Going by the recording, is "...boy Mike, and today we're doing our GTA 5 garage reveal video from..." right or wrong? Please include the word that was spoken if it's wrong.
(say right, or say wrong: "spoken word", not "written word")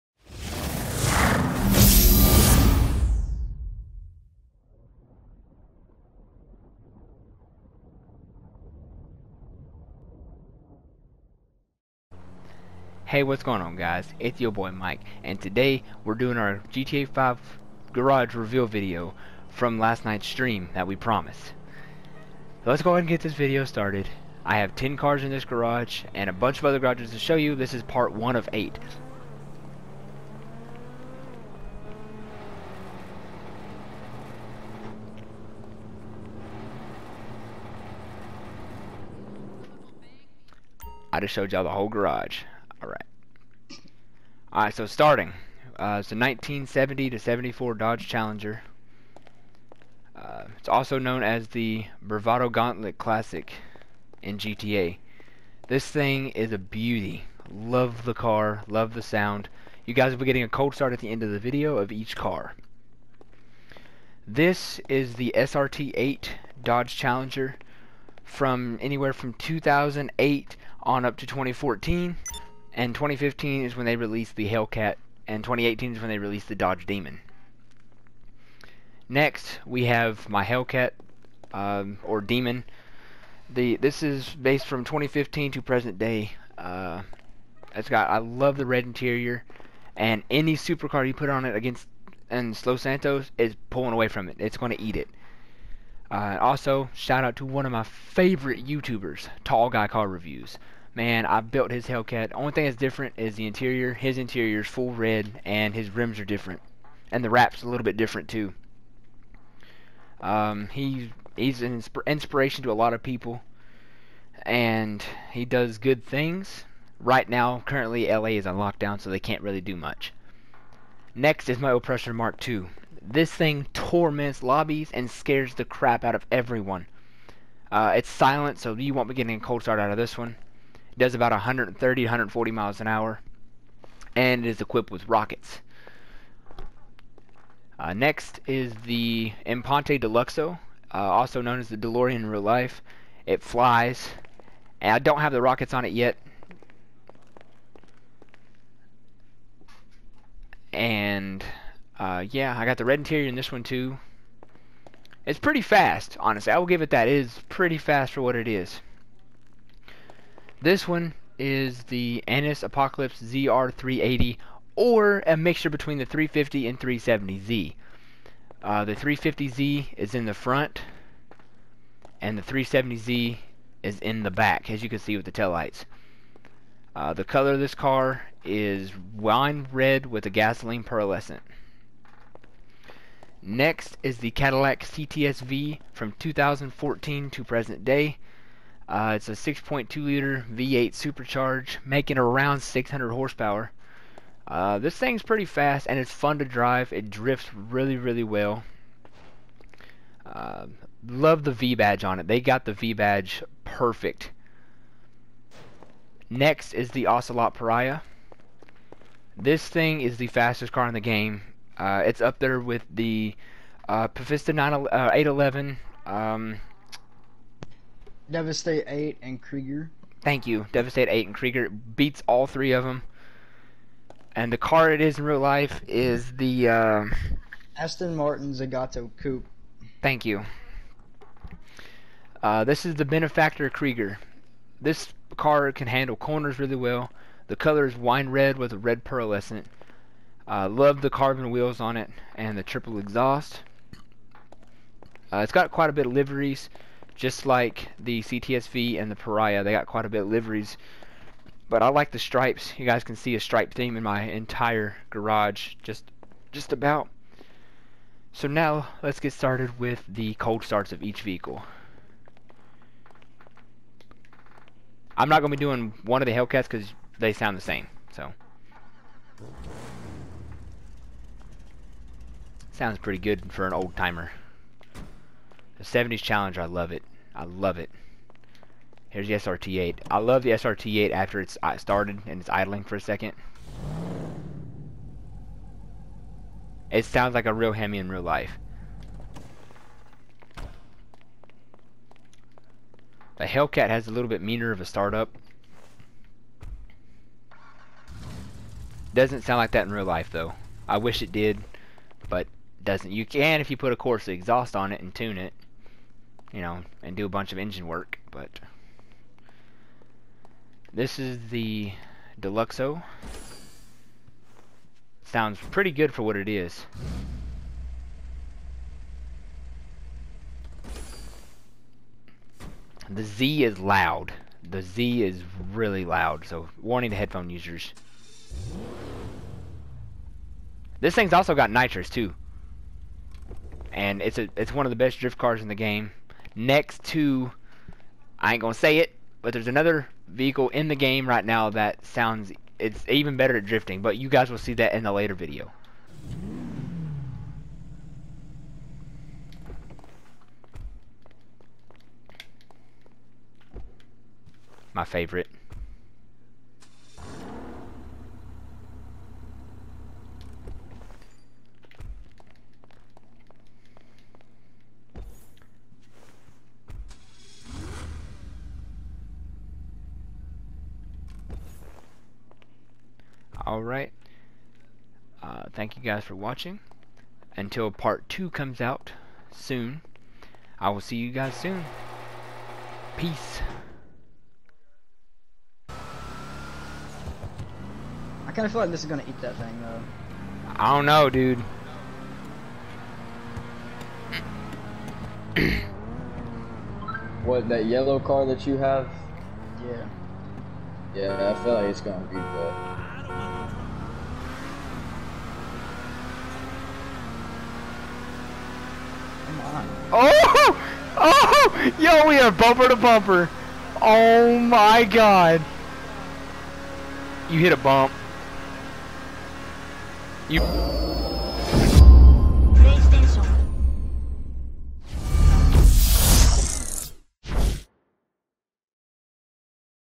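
right.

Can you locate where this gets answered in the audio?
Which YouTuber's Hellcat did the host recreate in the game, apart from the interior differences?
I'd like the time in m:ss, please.
1:39.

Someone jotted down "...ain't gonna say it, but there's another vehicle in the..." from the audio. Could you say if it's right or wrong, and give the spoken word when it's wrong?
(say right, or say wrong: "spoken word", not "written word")
right.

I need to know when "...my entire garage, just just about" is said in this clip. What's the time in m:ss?
4:14.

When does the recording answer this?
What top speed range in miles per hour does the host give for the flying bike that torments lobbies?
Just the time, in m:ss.
2:11.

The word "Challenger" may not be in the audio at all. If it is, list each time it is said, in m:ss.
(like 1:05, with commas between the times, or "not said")
0:48, 1:06, 4:36.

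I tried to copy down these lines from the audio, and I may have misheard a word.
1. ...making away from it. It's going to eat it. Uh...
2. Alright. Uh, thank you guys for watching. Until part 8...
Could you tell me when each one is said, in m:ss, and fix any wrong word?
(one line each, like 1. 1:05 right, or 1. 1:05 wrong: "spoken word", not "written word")
1. 1:33 wrong: "pulling", not "making"
2. 6:13 wrong: "2", not "8".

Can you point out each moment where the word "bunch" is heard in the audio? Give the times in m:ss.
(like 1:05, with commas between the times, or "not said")
0:26, 5:07.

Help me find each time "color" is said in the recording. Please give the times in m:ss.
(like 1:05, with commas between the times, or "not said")
2:57, 3:57.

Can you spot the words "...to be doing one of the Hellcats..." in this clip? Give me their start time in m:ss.
4:25.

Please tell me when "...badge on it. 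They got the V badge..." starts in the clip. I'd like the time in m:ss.
3:21.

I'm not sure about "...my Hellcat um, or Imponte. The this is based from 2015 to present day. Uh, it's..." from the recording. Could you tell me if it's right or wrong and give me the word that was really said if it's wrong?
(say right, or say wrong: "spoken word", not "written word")
wrong: "Demon", not "Imponte".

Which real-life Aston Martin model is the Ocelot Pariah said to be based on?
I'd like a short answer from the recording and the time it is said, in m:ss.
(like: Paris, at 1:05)
Zagato Coupe, at 3:48.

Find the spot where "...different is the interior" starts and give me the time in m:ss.
1:42.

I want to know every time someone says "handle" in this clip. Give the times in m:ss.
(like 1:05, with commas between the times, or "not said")
3:55.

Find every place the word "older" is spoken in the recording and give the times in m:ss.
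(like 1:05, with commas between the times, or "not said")
not said.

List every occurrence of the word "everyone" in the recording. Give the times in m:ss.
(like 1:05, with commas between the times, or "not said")
2:06.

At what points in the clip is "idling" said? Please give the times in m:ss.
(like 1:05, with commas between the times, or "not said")
4:42.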